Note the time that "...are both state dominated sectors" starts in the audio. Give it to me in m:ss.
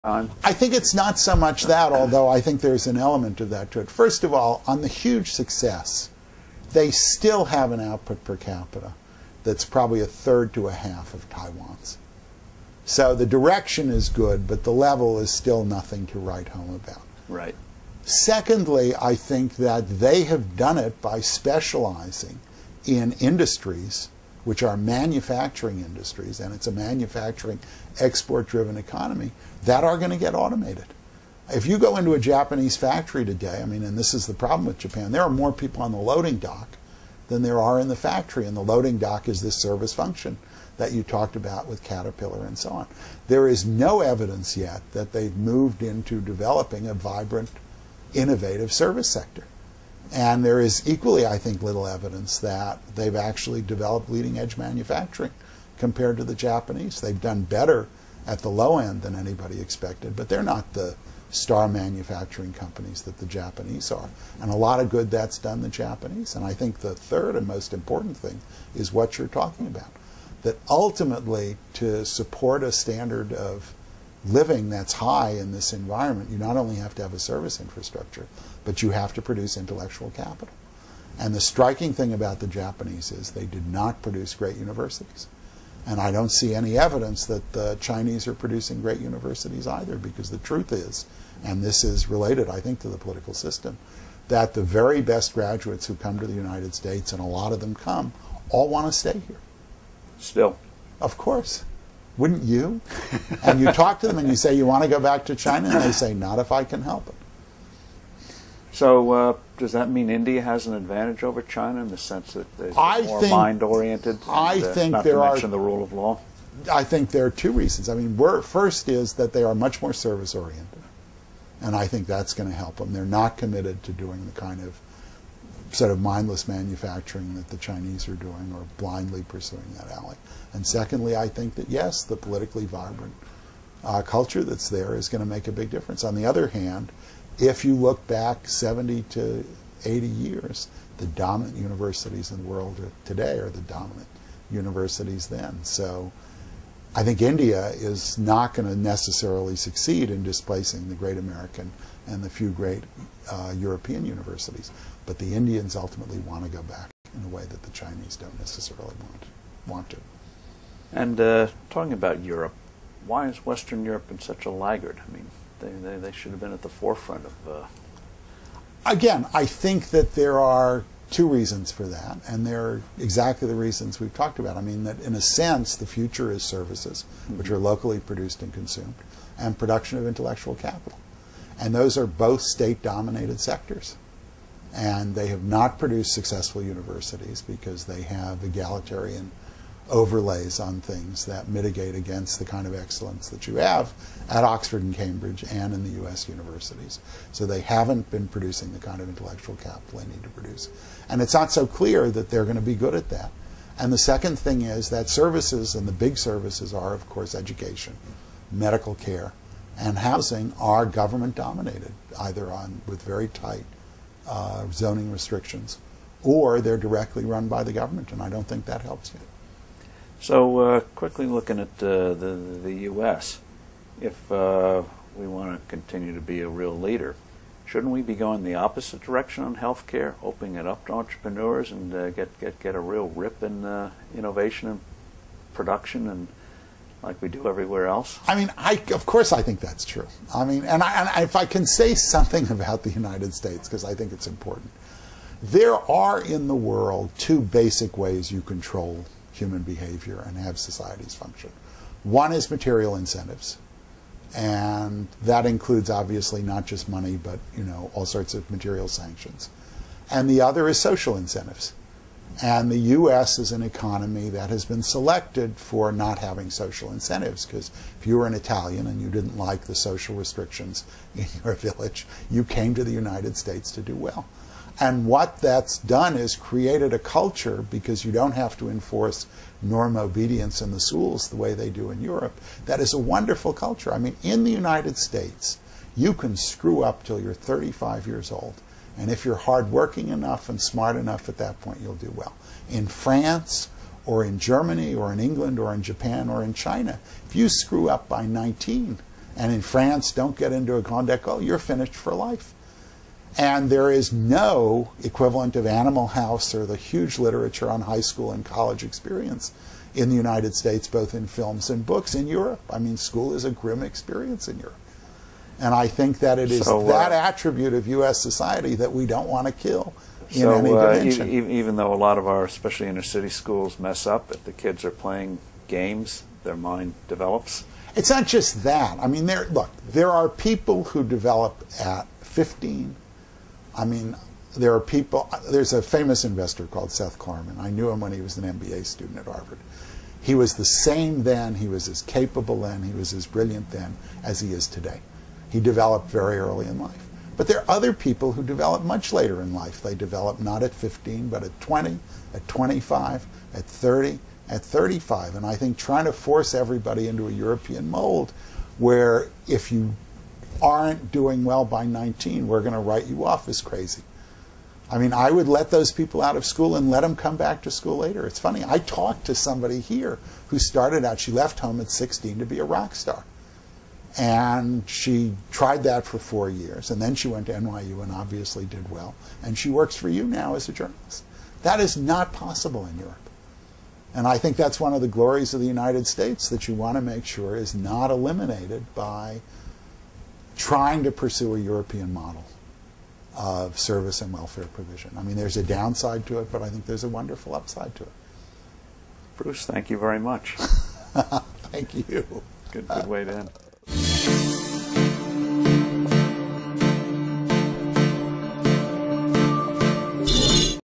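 3:01.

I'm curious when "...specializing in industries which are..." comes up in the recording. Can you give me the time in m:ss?
0:21.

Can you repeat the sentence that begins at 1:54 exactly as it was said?
I uh, think not there to mention the rule of law?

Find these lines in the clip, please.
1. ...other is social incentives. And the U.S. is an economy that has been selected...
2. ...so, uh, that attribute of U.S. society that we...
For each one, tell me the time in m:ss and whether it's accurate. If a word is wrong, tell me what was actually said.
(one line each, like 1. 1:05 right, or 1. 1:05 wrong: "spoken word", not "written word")
1. 4:20 right
2. 5:16 right.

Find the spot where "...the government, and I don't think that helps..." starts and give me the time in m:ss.
3:37.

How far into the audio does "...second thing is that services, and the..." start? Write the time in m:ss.
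3:23.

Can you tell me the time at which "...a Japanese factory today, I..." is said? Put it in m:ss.
0:32.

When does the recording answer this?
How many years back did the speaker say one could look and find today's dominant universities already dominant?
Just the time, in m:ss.
2:18.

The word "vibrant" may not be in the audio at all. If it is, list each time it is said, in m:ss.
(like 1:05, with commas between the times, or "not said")
0:46, 2:12.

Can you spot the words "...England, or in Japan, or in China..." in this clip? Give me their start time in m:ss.
4:55.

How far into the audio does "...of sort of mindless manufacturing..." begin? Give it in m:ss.
2:04.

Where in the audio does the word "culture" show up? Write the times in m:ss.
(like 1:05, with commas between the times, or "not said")
2:14, 4:36, 4:43.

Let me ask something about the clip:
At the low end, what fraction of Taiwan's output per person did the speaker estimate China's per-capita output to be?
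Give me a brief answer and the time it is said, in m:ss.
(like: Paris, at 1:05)
a third, at 0:09.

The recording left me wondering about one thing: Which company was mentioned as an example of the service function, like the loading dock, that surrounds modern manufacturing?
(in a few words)
Caterpillar.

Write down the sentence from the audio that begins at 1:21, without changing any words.
And the striking thing about the Japanese is they did not produce great universities.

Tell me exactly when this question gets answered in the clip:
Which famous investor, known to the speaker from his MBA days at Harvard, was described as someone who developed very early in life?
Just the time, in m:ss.
5:36.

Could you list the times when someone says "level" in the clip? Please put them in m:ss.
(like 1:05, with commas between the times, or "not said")
0:14.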